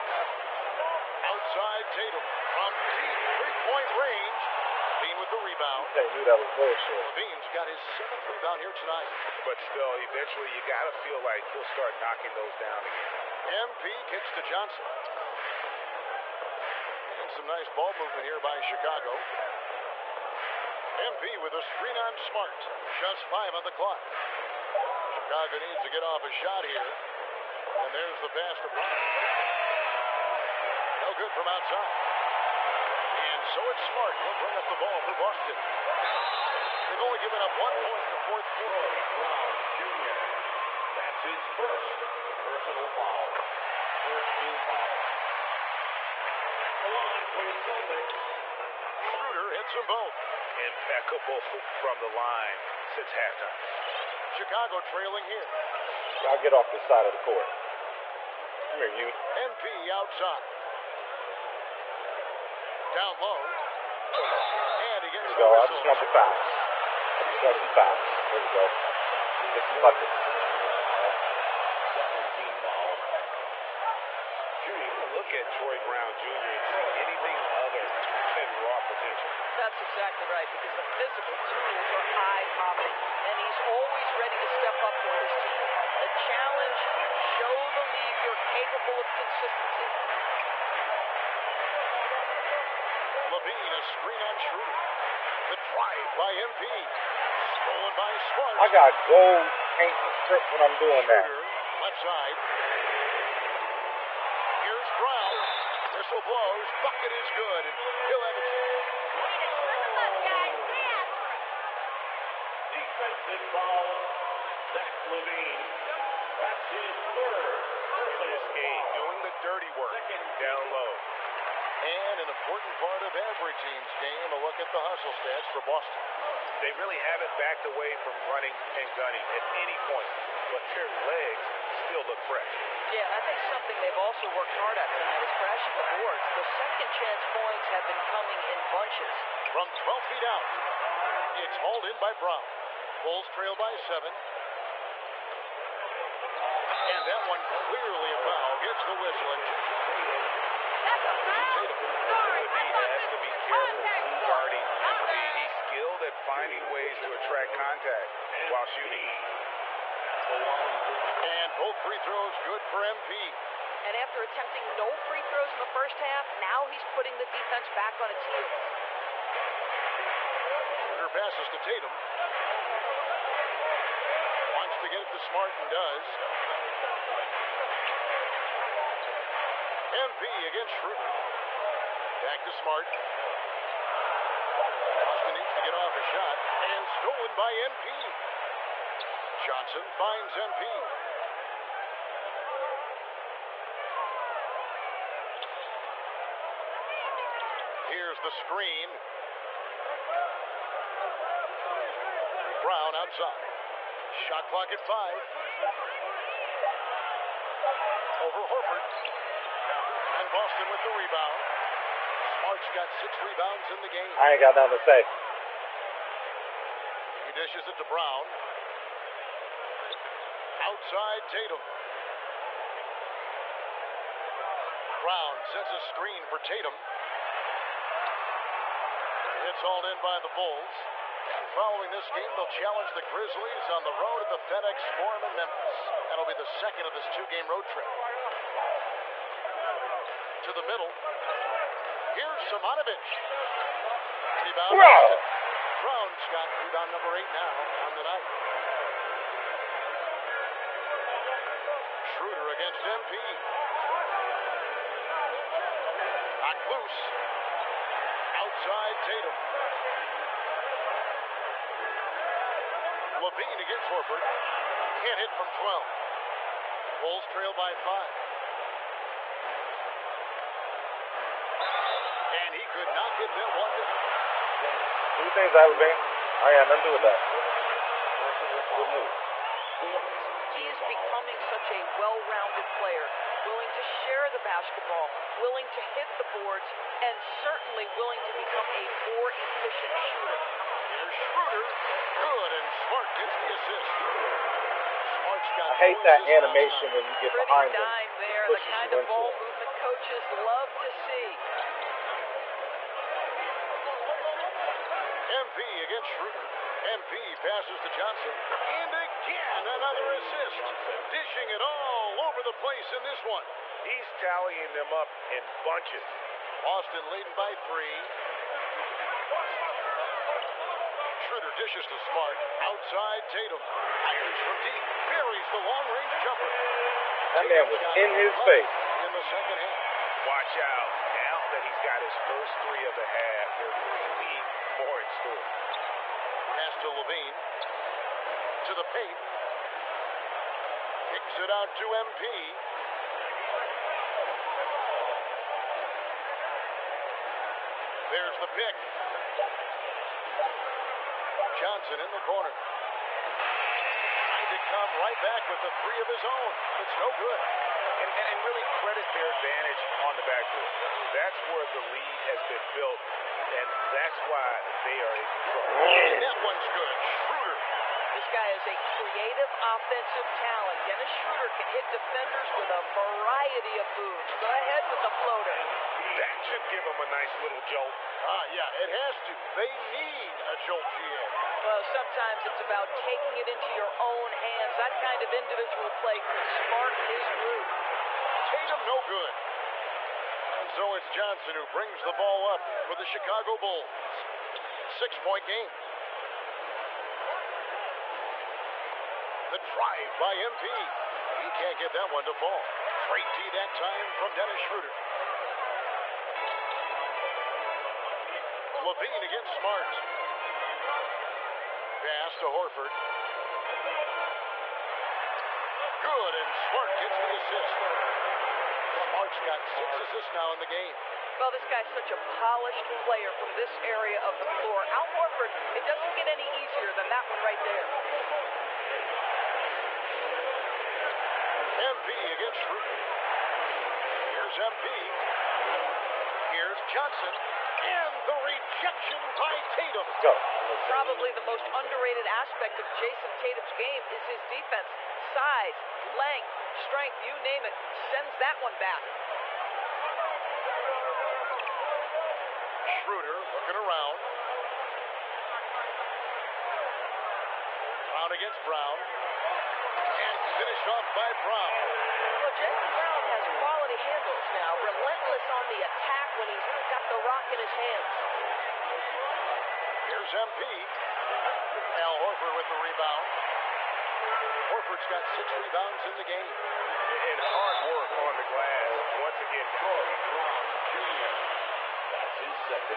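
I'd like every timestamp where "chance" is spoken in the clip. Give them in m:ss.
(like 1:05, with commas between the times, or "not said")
1:48, 2:16.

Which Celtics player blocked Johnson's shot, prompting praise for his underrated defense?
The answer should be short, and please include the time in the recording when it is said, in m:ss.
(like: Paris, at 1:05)
Jayson Tatum, at 7:18.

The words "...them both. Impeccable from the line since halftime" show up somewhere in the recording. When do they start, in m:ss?
0:49.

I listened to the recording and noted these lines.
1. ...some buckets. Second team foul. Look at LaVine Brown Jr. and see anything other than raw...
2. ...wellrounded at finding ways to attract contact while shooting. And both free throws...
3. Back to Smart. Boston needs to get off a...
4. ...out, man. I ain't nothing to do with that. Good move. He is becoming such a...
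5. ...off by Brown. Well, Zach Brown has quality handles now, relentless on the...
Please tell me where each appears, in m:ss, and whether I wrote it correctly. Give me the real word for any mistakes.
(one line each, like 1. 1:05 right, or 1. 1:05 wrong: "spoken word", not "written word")
1. 1:09 wrong: "Troy", not "LaVine"
2. 2:35 wrong: "skilled", not "wellrounded"
3. 3:02 right
4. 4:35 right
5. 7:40 wrong: "Jaylen", not "Zach".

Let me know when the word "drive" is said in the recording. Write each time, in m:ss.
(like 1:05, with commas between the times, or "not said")
1:35, 6:39.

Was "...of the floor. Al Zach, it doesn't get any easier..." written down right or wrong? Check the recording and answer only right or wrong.
wrong.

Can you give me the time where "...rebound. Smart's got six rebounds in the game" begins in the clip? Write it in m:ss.
3:30.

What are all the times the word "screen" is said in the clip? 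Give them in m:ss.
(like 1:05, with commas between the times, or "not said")
0:21, 1:33, 3:18, 3:45.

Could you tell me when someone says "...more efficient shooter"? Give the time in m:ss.
4:49.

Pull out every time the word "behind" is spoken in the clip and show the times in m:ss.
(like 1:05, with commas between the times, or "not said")
4:57.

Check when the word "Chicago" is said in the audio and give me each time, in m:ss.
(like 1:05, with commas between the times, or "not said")
0:18, 0:25, 0:54, 6:33.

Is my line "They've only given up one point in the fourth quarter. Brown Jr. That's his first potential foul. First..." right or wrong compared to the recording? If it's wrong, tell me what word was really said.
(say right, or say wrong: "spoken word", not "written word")
wrong: "personal", not "potential".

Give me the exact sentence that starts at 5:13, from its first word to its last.
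He's tallying them up in bunches.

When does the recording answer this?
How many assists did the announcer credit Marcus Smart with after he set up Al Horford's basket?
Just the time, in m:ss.
6:59.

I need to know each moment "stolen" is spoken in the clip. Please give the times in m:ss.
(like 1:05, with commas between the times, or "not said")
1:37, 3:06.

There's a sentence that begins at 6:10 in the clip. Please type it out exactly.
Dennis Schroeder can hit defenders with a variety of moves.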